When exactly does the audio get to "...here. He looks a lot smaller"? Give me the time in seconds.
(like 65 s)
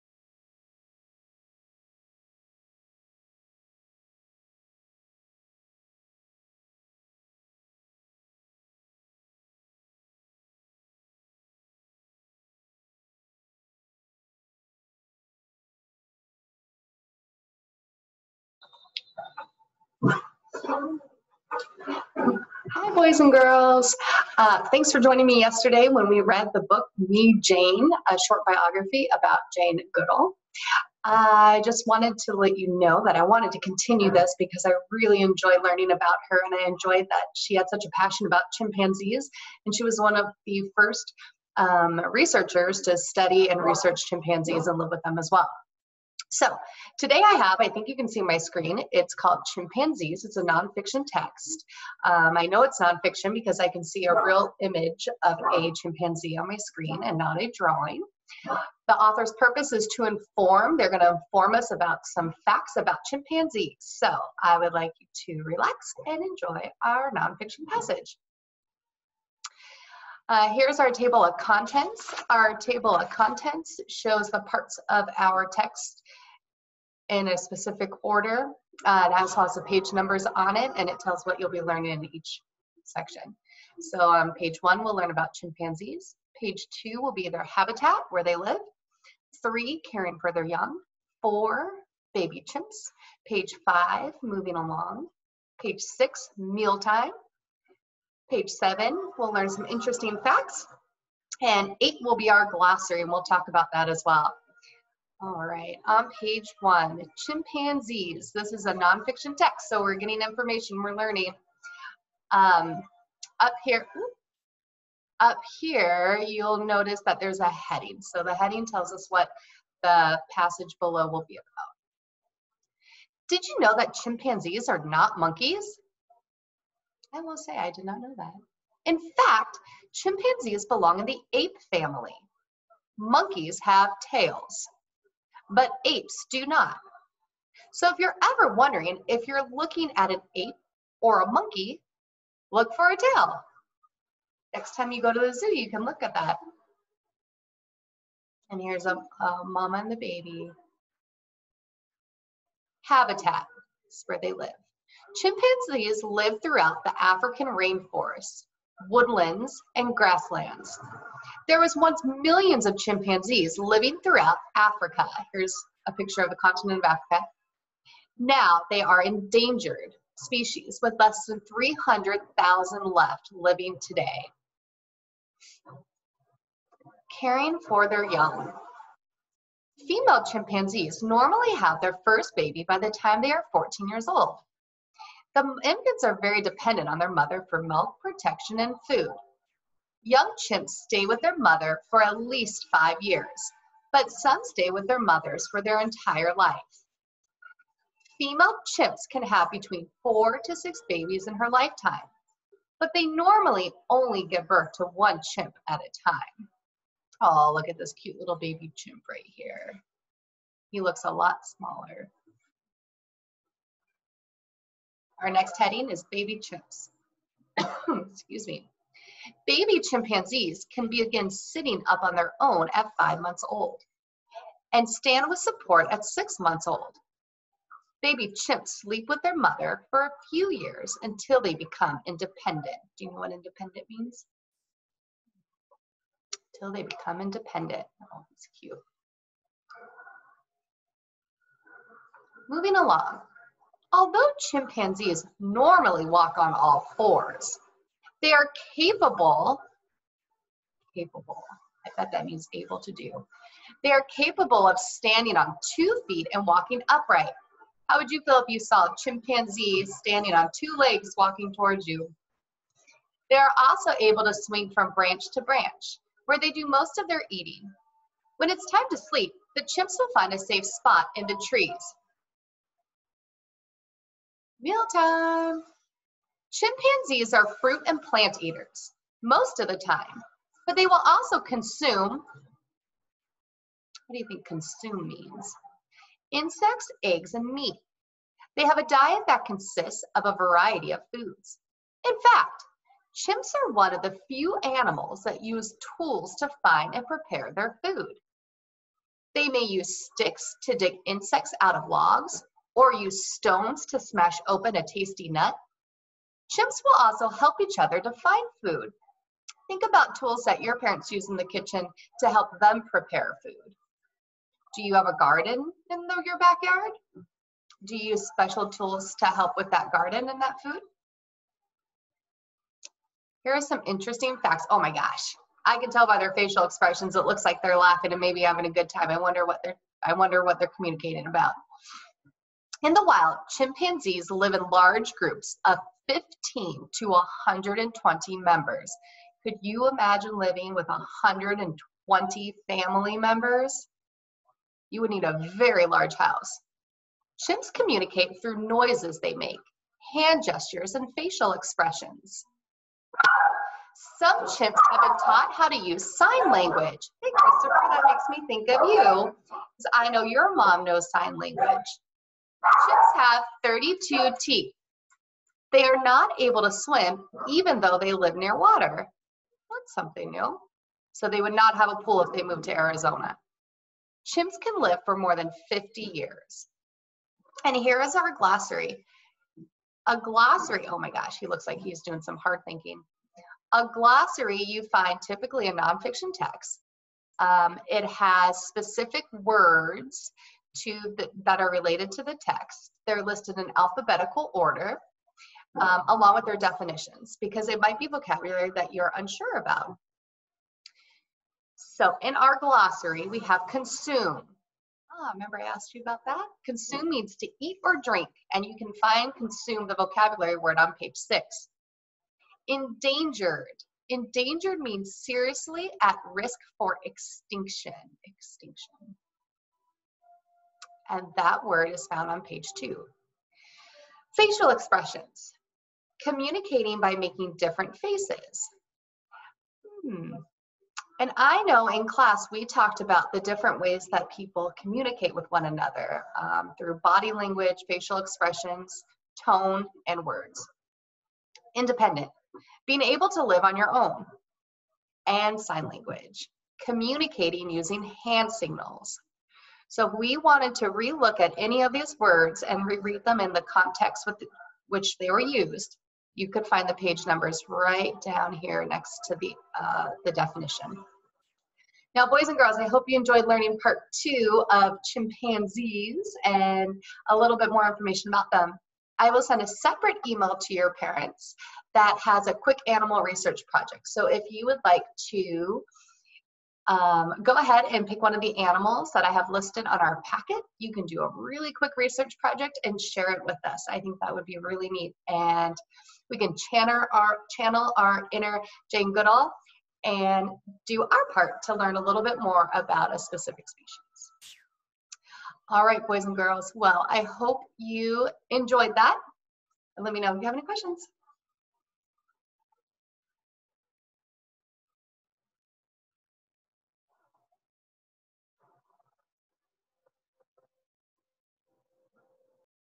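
209 s.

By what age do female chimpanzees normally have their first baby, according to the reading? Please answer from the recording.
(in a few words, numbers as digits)
14 years old.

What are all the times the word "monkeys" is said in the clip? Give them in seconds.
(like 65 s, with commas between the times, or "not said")
125 s, 132 s, 141 s.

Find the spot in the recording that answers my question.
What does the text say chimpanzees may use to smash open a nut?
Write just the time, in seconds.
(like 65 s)
303 s.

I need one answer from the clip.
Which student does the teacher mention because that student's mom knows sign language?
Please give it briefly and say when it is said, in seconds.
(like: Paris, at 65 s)
Christopher, at 357 s.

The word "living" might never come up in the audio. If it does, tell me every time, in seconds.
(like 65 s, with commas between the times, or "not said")
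163 s, 173 s, 340 s.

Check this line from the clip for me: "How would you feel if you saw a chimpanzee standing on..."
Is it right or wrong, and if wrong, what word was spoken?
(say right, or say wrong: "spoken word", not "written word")
right.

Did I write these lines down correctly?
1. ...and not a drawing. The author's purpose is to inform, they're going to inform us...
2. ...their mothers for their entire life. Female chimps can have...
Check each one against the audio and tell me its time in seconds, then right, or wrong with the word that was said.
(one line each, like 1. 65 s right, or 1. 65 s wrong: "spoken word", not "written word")
1. 57 s right
2. 194 s right.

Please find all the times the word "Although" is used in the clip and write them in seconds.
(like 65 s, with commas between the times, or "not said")
243 s.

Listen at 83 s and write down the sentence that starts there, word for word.
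So on um, page one, we'll learn about chimpanzees.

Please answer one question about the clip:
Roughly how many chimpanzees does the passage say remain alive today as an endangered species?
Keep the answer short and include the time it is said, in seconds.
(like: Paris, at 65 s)
less than 300,000, at 170 s.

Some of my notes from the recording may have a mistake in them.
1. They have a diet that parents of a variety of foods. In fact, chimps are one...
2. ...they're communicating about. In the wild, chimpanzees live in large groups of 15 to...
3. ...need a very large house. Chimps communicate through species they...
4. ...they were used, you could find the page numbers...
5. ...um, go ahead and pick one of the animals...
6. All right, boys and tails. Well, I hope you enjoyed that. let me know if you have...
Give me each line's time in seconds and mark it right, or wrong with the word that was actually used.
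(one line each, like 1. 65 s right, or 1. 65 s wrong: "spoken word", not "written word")
1. 288 s wrong: "consists", not "parents"
2. 330 s right
3. 345 s wrong: "noises", not "species"
4. 455 s right
5. 476 s right
6. 495 s wrong: "girls", not "tails".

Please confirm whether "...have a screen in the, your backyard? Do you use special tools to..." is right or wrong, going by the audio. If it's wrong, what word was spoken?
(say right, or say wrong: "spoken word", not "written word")
wrong: "garden", not "screen".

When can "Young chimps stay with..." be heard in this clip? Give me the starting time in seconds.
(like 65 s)
190 s.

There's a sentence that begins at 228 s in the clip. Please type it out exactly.
Baby chimps sleep with their mother for a few years until they become independent.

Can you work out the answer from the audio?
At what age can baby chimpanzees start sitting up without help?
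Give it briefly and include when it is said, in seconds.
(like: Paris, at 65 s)
5 months old, at 222 s.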